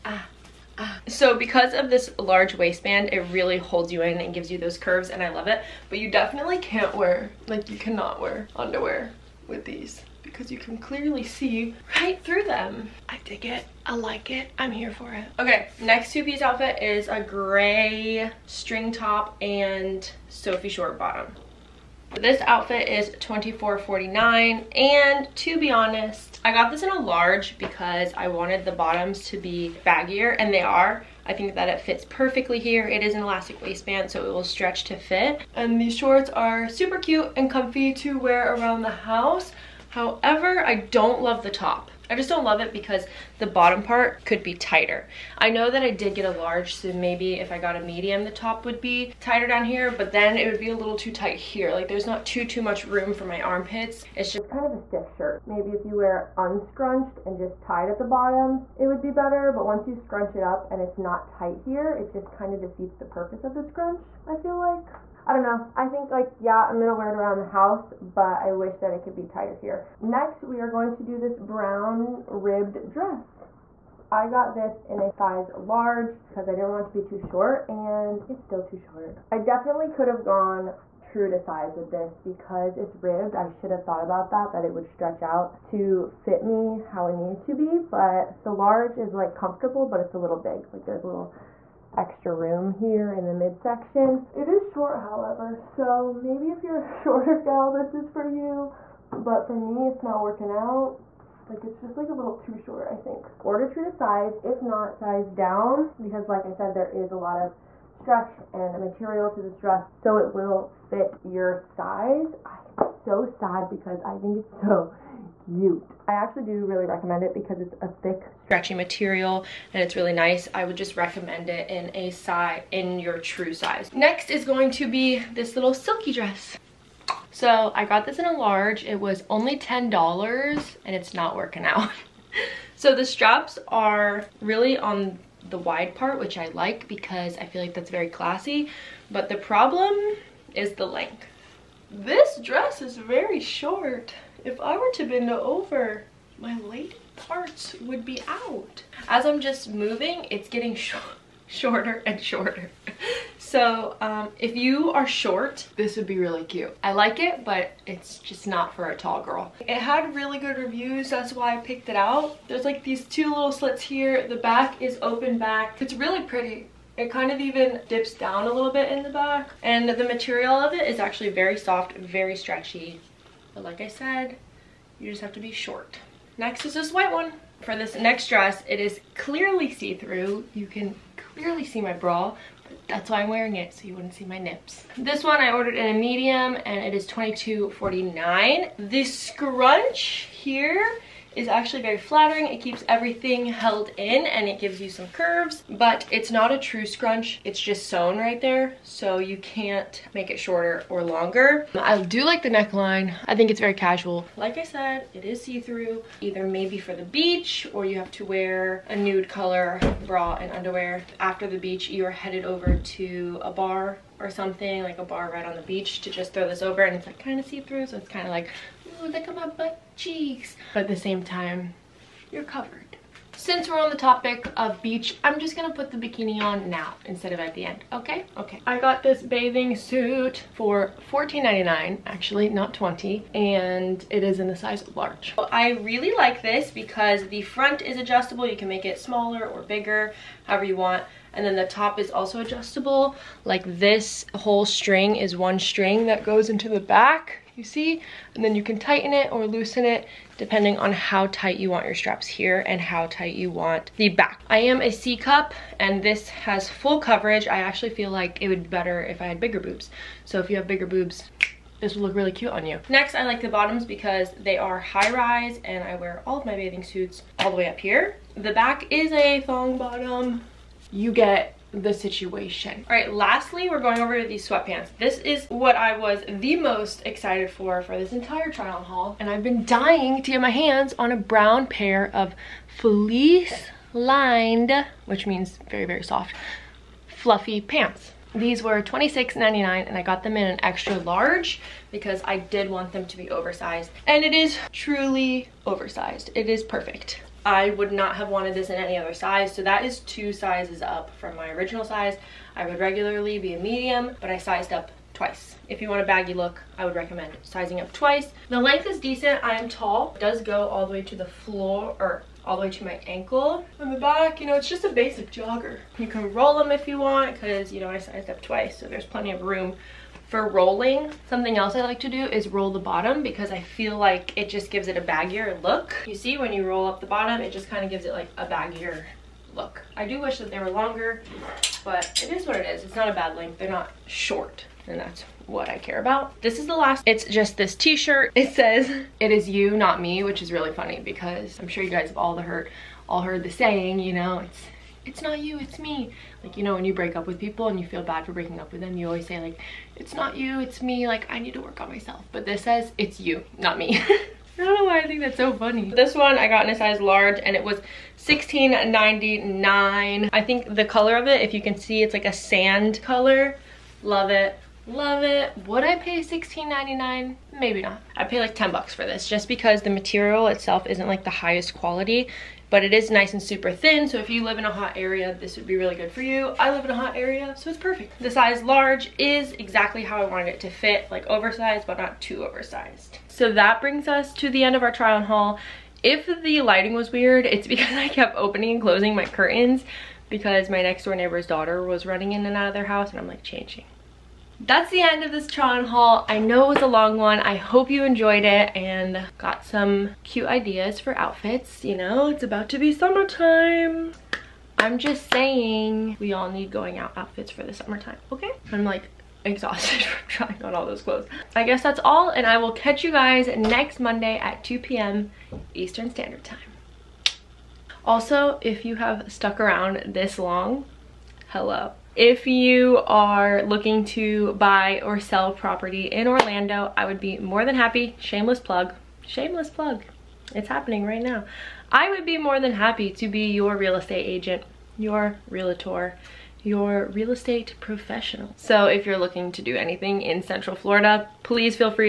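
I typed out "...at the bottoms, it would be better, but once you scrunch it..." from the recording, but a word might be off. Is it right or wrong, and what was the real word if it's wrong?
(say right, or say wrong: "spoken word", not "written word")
right.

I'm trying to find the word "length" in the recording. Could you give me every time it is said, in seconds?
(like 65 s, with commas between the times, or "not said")
140 s, 308 s, 333 s.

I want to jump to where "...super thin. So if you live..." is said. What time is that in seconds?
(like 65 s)
373 s.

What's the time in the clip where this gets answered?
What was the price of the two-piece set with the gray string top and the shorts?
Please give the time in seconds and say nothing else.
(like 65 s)
23 s.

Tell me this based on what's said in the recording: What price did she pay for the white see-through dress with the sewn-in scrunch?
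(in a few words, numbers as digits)
$22.49.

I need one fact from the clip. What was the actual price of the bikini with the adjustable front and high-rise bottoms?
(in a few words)
$14.99.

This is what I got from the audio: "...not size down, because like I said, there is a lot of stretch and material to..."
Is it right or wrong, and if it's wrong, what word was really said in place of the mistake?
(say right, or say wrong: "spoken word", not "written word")
right.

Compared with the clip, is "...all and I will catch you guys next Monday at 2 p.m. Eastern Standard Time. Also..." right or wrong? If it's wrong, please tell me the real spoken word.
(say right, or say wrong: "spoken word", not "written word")
right.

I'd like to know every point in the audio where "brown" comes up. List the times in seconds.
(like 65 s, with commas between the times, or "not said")
71 s, 281 s.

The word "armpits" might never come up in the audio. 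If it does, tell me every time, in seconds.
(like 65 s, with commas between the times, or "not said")
53 s.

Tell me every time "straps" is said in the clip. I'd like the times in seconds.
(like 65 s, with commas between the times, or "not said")
133 s, 251 s.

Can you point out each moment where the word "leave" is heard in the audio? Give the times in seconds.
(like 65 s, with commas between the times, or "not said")
not said.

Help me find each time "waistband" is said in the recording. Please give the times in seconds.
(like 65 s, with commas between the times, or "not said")
2 s, 33 s.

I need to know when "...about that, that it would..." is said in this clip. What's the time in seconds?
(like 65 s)
84 s.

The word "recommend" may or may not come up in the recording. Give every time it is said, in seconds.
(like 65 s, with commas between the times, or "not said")
116 s, 120 s, 306 s.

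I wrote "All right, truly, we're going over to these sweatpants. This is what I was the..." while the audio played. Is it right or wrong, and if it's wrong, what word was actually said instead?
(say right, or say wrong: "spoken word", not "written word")
wrong: "lastly", not "truly".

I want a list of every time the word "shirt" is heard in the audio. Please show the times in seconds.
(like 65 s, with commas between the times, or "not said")
55 s, 337 s.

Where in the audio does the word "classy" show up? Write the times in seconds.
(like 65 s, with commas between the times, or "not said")
138 s.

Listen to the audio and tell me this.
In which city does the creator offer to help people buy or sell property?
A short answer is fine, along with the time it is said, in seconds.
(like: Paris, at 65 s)
Orlando, at 426 s.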